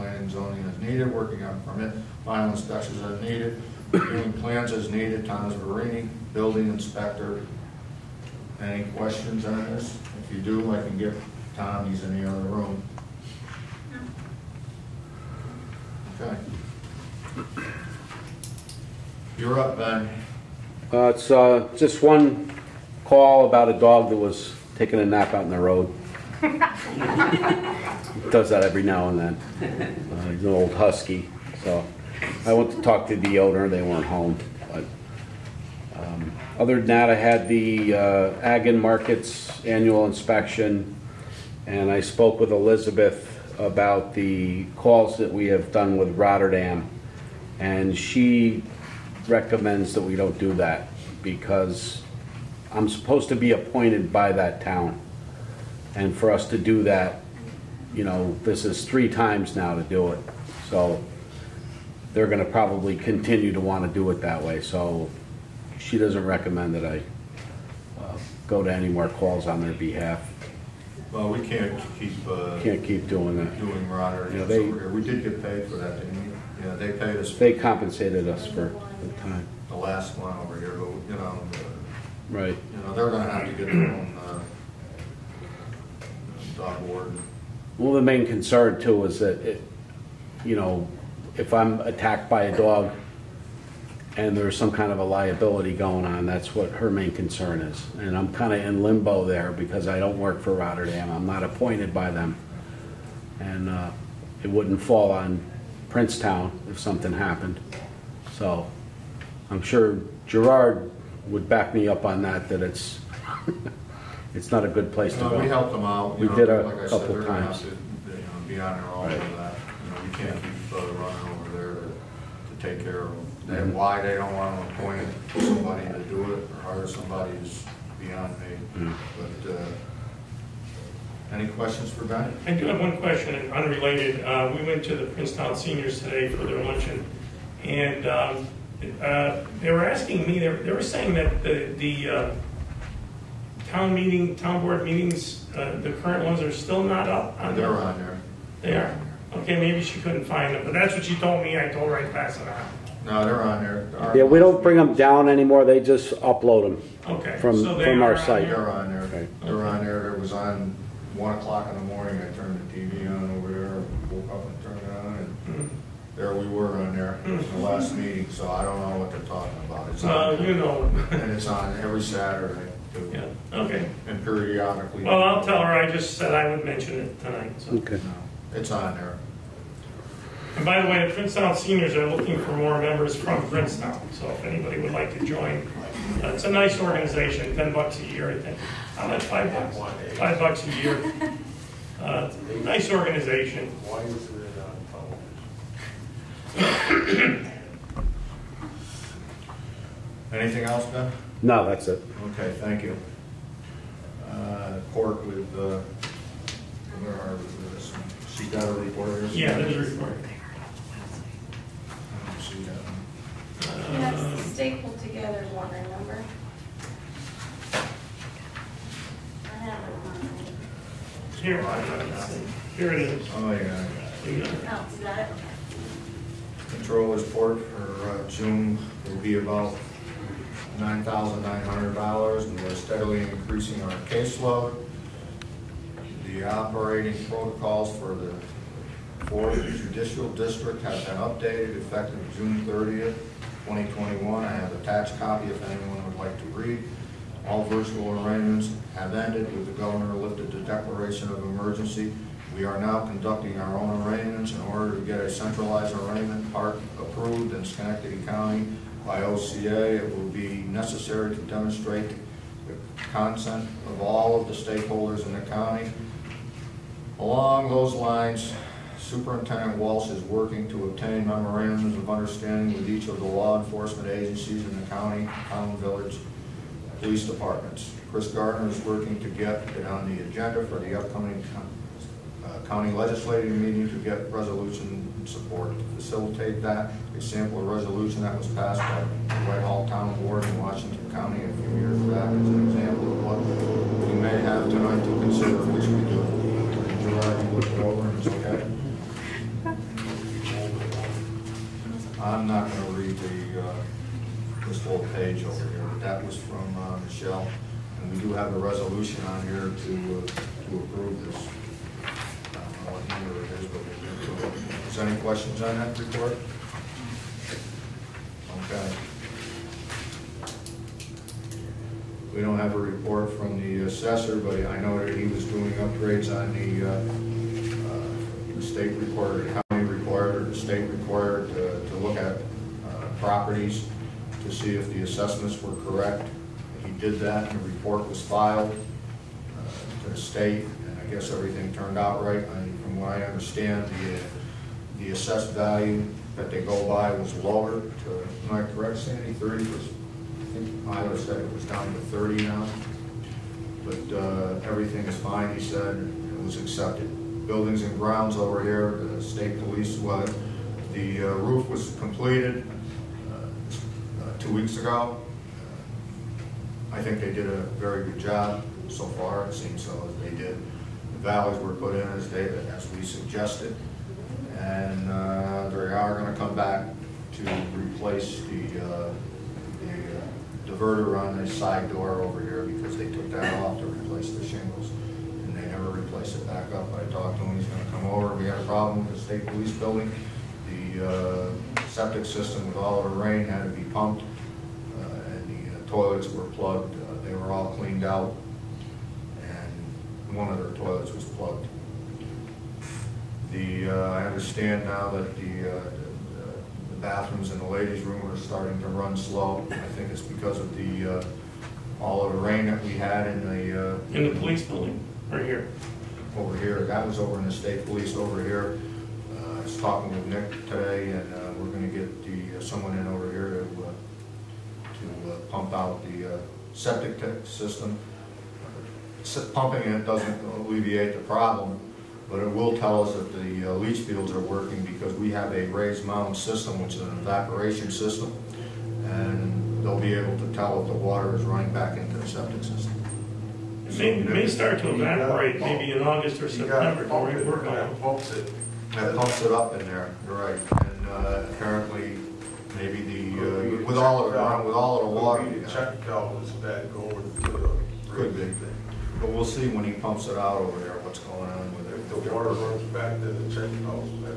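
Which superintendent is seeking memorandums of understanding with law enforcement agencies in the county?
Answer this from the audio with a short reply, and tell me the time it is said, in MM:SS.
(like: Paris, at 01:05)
Walsh, at 04:29.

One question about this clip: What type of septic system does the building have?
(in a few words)
raised mound system.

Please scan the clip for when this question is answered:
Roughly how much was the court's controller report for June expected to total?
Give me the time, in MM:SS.
03:50.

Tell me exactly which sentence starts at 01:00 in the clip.
So they're going to probably continue to want to do it that way.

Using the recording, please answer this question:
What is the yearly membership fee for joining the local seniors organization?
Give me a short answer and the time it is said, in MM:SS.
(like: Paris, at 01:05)
Five bucks, at 03:10.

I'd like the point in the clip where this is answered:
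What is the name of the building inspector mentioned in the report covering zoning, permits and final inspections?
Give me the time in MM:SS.
00:05.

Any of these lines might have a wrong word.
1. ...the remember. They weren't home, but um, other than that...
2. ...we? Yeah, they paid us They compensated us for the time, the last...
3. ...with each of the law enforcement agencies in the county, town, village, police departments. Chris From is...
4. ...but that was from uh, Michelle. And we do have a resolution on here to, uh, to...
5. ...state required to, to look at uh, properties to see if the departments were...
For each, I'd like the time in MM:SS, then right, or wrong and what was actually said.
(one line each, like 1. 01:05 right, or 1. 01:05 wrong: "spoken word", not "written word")
1. 00:33 wrong: "owner", not "remember"
2. 01:16 right
3. 04:32 wrong: "Gardner", not "From"
4. 05:05 right
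5. 05:30 wrong: "assessments", not "departments".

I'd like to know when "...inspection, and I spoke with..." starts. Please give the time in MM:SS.
00:40.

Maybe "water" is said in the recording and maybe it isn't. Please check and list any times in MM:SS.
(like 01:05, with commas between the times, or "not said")
07:20, 07:35, 07:42.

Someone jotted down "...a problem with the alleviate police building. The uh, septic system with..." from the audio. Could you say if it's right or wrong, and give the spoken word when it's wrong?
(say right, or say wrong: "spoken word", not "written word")
wrong: "state", not "alleviate".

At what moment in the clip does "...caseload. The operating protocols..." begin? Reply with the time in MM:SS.
03:54.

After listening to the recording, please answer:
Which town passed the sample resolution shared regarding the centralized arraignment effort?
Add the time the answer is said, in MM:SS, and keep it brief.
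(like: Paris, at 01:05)
Whitehall, at 04:49.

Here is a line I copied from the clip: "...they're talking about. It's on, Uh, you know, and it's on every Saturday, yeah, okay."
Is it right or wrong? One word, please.
right.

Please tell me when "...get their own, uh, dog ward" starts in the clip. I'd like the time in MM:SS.
01:23.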